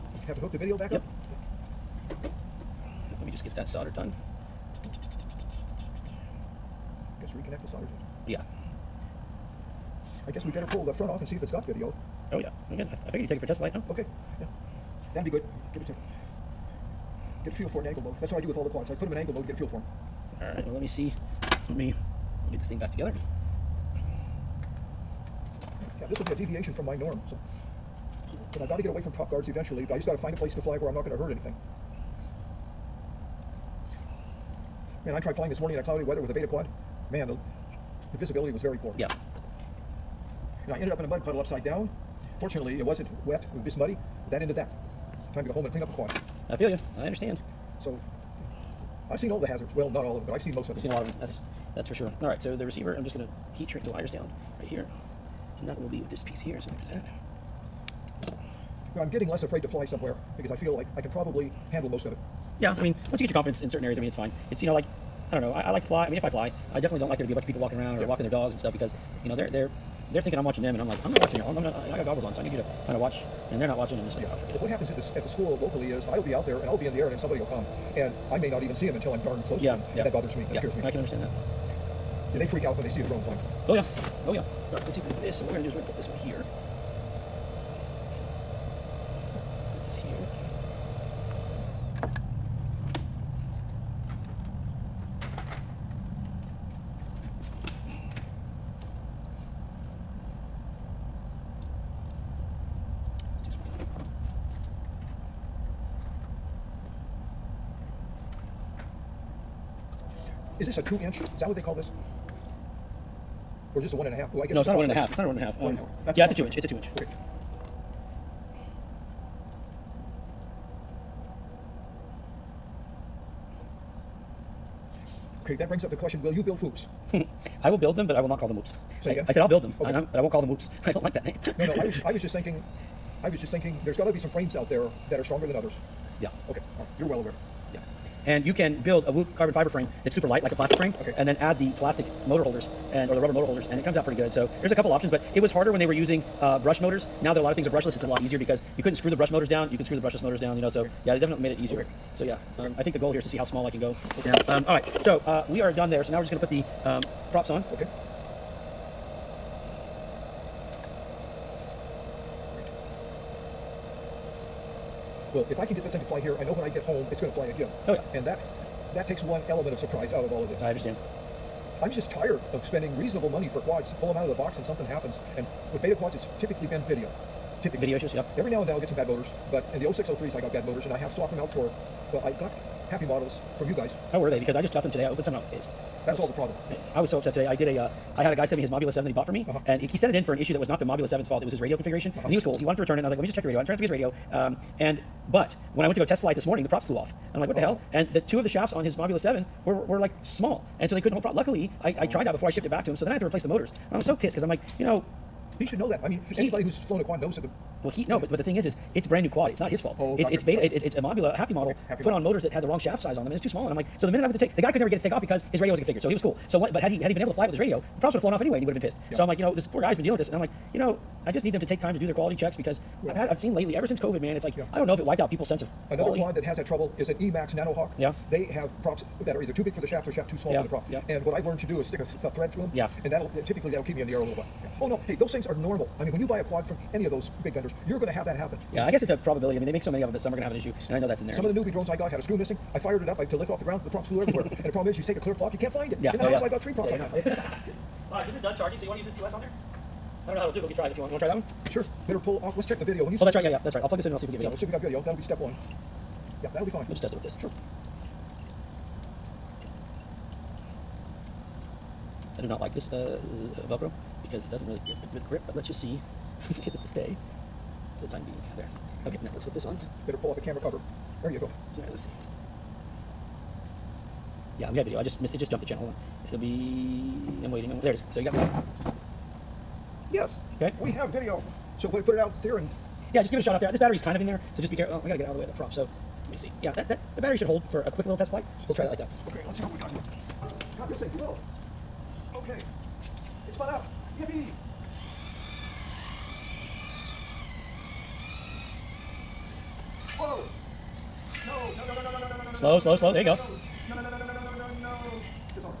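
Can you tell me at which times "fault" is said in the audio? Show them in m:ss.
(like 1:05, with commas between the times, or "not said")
3:11, 3:29.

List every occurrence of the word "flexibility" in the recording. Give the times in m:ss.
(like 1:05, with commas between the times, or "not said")
not said.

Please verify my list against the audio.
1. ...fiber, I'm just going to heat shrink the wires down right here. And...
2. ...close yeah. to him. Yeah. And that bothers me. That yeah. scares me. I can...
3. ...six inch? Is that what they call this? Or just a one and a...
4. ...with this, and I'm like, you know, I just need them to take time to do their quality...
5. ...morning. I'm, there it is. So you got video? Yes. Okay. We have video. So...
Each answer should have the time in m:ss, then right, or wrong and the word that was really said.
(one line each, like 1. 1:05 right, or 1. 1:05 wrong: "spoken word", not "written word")
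1. 0:52 wrong: "receiver", not "fiber"
2. 1:19 right
3. 1:50 wrong: "two", not "six"
4. 3:40 right
5. 4:37 wrong: "waiting", not "morning".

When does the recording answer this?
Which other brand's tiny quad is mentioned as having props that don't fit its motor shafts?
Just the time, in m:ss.
3:47.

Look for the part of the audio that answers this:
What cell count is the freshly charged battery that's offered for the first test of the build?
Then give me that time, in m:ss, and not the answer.
4:09.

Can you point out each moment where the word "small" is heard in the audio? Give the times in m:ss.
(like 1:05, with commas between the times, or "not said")
2:33, 3:20, 3:33, 3:50.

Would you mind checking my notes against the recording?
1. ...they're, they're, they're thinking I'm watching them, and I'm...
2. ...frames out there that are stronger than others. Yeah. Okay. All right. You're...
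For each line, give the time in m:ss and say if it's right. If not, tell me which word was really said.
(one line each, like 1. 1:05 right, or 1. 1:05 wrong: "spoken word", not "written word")
1. 1:09 right
2. 2:14 right.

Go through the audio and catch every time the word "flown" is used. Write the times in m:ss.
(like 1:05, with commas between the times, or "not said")
3:26, 3:38.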